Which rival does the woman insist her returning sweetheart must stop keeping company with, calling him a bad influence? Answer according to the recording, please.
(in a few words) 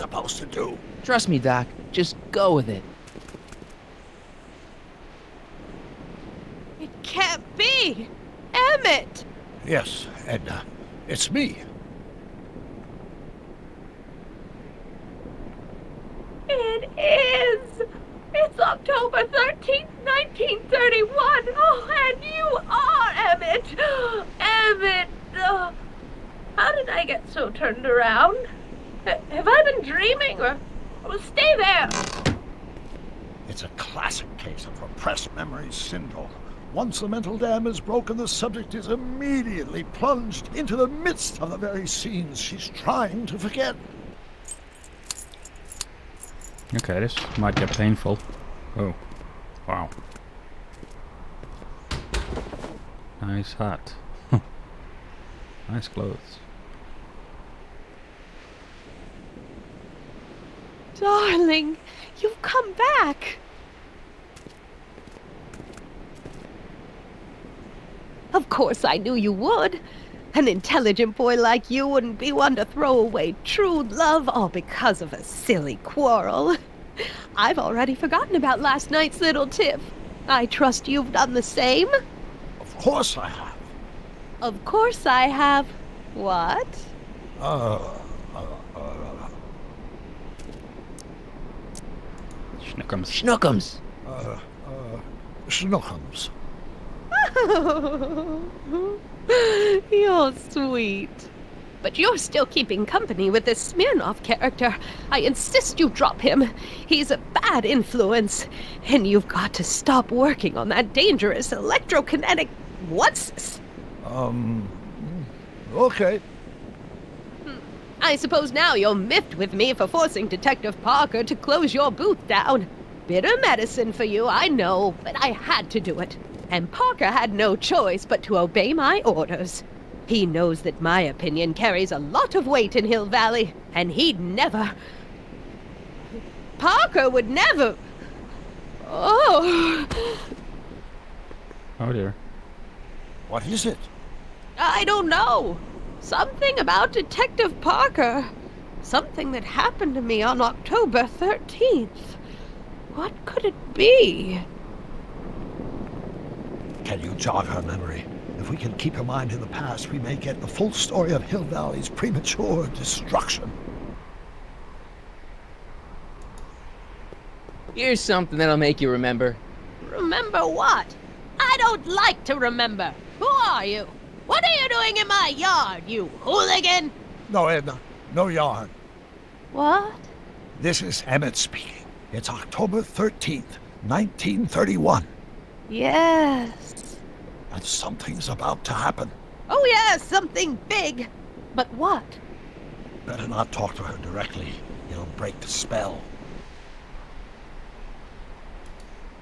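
Smirnoff.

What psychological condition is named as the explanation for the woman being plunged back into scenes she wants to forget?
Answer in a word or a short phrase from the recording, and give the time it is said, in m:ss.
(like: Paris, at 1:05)
repressed memory syndrome, at 0:34.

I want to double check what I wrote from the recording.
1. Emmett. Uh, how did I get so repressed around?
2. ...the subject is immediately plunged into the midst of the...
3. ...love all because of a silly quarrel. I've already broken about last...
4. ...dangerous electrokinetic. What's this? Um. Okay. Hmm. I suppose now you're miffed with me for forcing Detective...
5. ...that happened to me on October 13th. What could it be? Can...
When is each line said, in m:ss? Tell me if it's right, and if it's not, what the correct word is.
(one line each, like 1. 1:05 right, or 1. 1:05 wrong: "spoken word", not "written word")
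1. 0:24 wrong: "turned", not "repressed"
2. 0:38 right
3. 1:13 wrong: "forgotten", not "broken"
4. 1:50 right
5. 2:29 right.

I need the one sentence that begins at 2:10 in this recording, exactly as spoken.
He knows that my opinion carries a lot of weight in Hill Valley, and he'd never...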